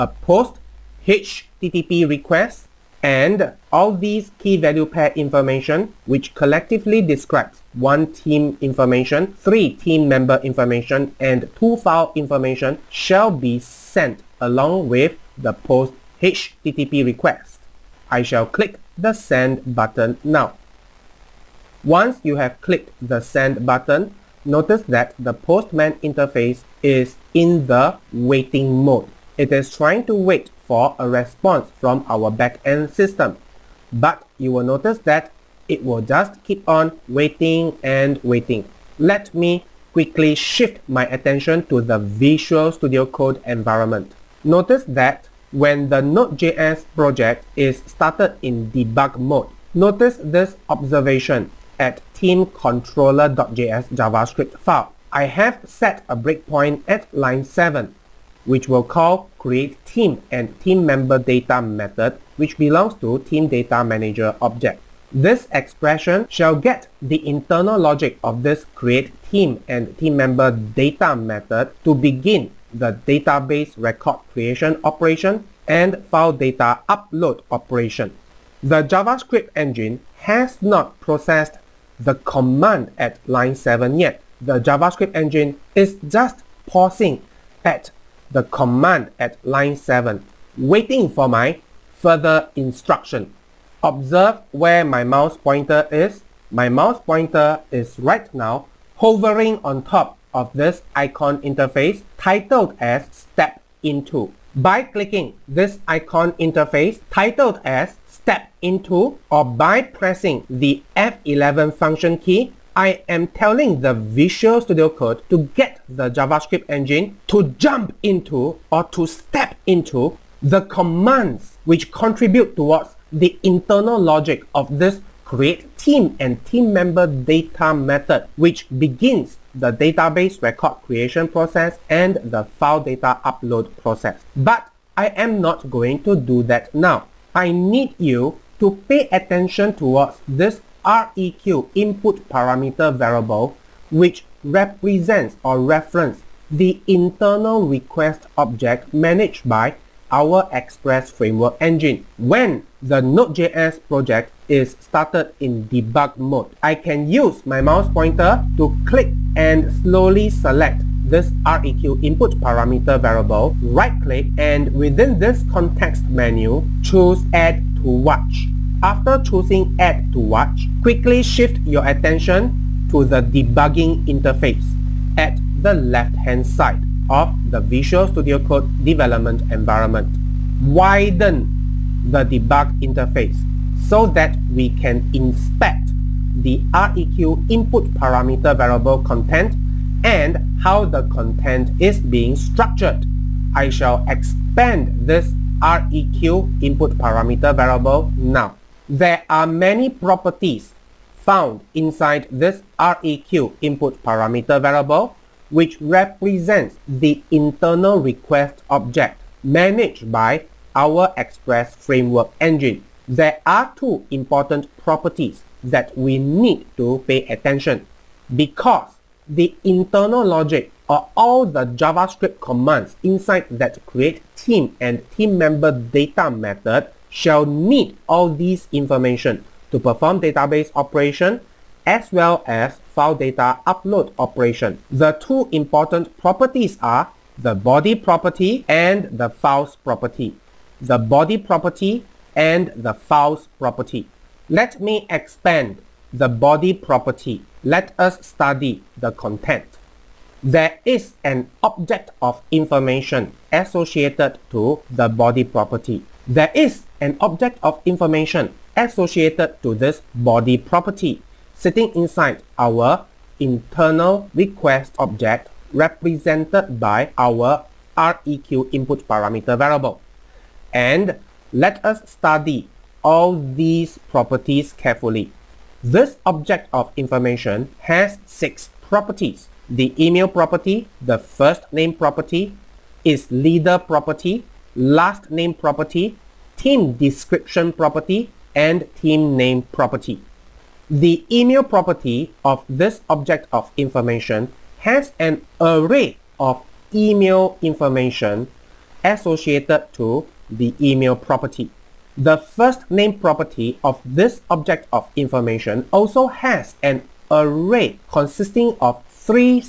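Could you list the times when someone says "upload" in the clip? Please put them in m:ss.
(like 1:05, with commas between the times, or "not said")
1:16, 2:13, 3:53.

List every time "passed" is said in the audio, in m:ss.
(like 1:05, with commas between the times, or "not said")
not said.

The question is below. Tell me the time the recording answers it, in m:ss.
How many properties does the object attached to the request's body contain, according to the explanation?
4:38.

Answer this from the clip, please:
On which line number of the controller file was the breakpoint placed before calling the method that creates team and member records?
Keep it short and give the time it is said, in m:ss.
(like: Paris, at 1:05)
7, at 0:57.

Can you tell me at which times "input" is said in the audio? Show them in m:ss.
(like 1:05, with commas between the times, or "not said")
2:21, 2:42, 3:07, 3:16, 3:23, 4:28.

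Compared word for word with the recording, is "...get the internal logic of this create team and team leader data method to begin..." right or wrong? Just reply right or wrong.
wrong.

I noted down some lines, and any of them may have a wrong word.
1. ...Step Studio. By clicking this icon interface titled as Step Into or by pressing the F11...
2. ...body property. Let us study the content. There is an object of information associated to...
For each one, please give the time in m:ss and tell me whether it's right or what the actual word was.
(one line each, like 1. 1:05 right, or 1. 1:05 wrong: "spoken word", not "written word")
1. 1:43 wrong: "Into", not "Studio"
2. 4:06 right.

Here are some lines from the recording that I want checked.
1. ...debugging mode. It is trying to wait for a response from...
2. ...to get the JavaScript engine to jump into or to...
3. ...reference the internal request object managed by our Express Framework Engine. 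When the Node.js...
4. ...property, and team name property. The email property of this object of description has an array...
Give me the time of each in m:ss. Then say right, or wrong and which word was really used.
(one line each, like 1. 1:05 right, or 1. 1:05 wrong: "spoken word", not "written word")
1. 0:28 wrong: "waiting", not "debugging"
2. 1:55 right
3. 2:25 right
4. 4:47 wrong: "information", not "description".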